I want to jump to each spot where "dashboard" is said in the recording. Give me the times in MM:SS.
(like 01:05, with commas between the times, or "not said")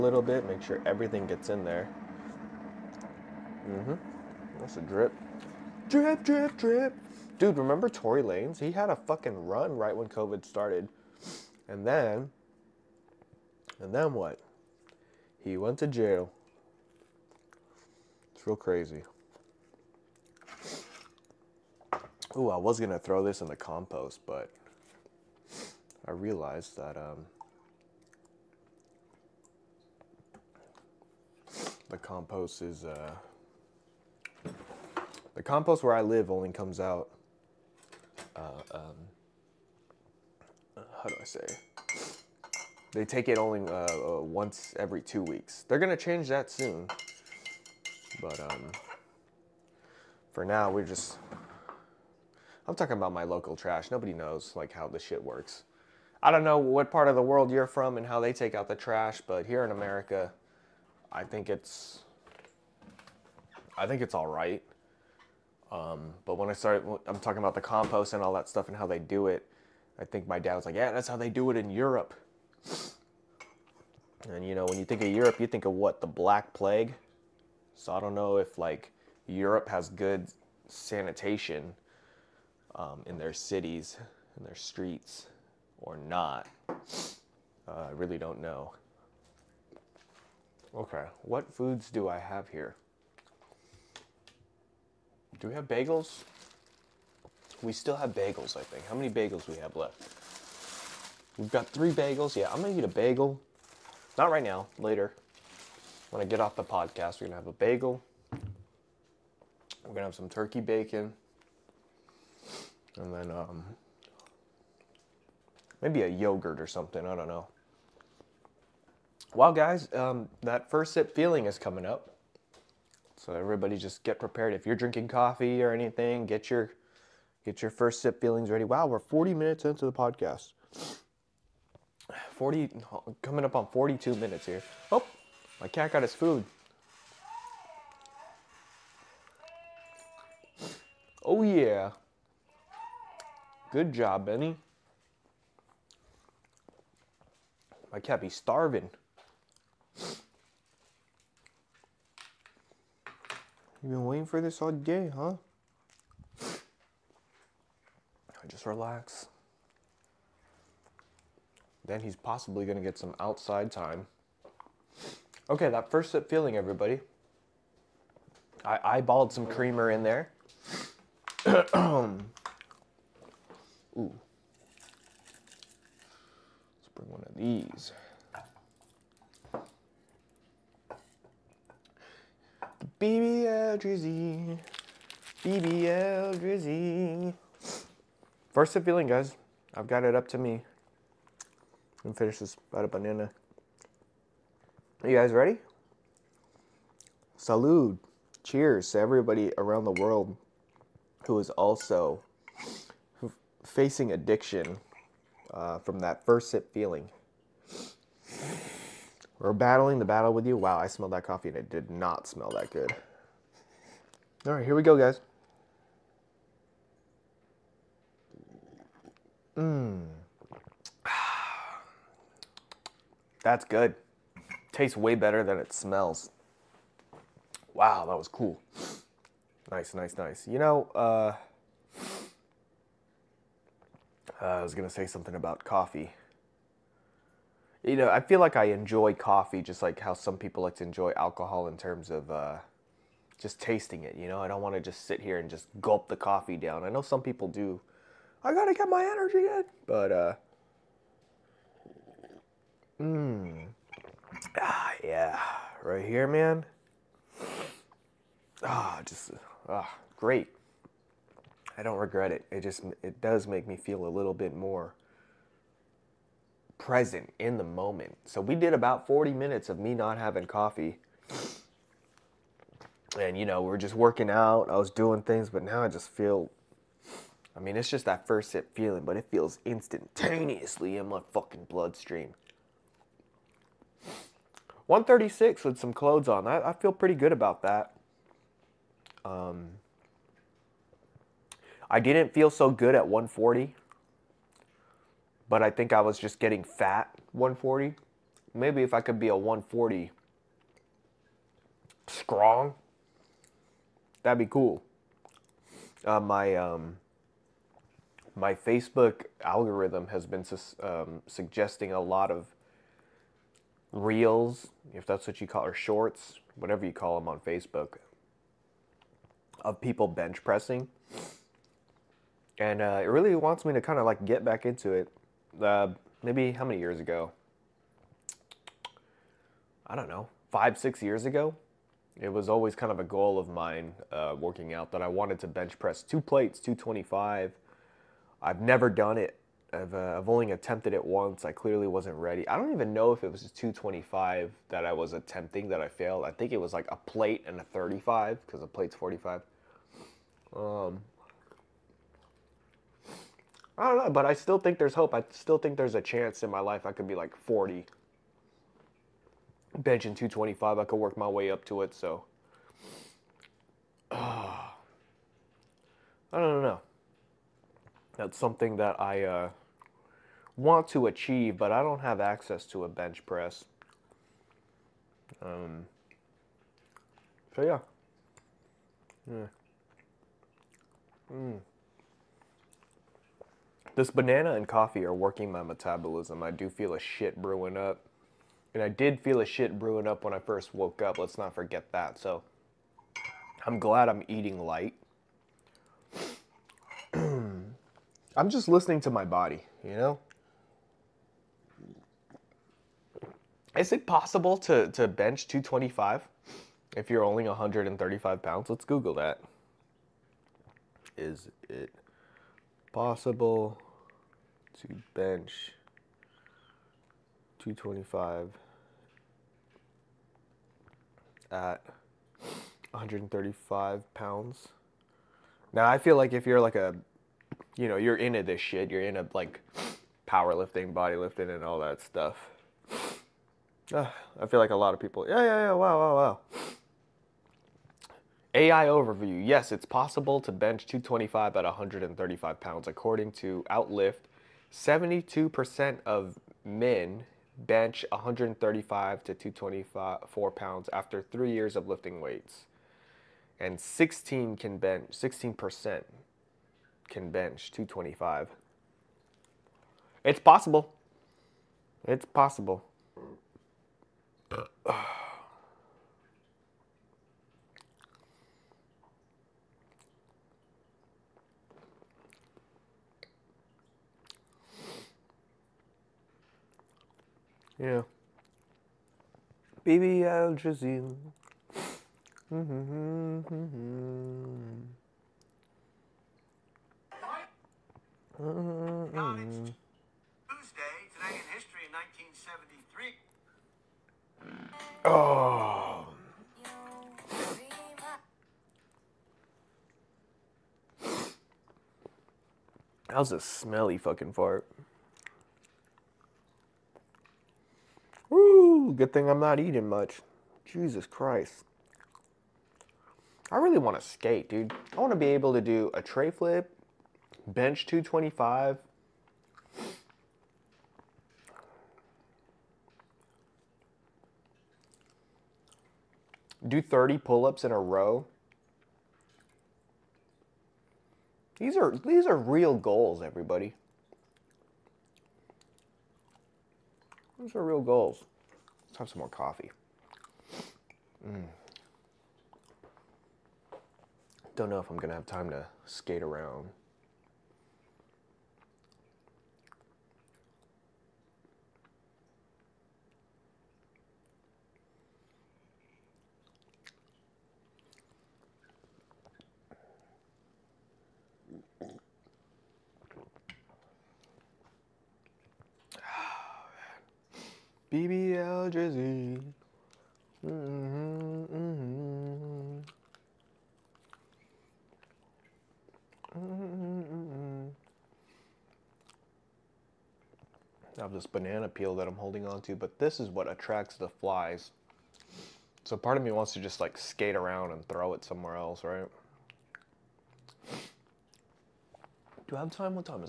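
not said.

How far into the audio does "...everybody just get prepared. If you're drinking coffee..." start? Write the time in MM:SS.
02:03.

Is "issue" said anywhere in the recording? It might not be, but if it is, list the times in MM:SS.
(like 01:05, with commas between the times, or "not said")
not said.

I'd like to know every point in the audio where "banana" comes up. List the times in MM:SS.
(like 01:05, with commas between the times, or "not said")
03:12, 06:24, 09:41.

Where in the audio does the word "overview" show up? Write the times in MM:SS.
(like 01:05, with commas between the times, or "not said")
07:18.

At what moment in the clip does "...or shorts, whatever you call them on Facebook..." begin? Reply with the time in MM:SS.
05:15.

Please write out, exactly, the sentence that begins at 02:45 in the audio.
Okay, that first sip feeling, everybody.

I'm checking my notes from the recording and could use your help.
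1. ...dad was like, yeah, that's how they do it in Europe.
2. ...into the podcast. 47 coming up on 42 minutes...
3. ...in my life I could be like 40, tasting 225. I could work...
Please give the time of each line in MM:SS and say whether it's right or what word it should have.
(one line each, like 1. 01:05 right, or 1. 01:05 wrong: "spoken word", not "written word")
1. 01:10 right
2. 02:09 wrong: "40", not "47"
3. 05:56 wrong: "benching", not "tasting".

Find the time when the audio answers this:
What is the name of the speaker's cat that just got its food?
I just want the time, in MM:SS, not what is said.
02:24.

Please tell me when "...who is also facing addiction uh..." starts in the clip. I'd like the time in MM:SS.
03:21.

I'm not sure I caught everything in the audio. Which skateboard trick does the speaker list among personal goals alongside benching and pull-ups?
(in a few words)
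tray flip.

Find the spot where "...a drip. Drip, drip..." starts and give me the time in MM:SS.
00:04.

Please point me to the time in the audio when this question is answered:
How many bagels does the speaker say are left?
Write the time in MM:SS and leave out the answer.
01:41.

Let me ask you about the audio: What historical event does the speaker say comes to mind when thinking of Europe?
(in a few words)
The Black Plague.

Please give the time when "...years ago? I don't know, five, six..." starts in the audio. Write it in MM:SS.
05:26.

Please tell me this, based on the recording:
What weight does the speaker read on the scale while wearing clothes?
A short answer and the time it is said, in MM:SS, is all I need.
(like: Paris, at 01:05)
136, at 04:44.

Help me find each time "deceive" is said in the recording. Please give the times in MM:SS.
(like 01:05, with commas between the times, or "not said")
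not said.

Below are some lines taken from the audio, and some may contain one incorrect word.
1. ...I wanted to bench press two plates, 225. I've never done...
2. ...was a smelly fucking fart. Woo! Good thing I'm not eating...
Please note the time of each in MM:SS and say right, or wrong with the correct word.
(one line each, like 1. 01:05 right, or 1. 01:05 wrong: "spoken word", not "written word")
1. 05:35 right
2. 08:23 right.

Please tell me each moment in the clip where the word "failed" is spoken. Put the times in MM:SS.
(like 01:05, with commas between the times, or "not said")
05:45.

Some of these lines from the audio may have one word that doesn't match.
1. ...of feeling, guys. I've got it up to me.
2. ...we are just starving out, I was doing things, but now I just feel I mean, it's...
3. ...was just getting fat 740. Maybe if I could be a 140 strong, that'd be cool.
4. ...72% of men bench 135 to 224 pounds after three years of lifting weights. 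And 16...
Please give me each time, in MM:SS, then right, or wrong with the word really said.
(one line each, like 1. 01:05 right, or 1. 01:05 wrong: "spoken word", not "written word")
1. 03:08 right
2. 04:33 wrong: "working", not "starving"
3. 04:56 wrong: "140", not "740"
4. 07:24 right.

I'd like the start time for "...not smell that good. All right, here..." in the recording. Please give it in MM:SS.
03:31.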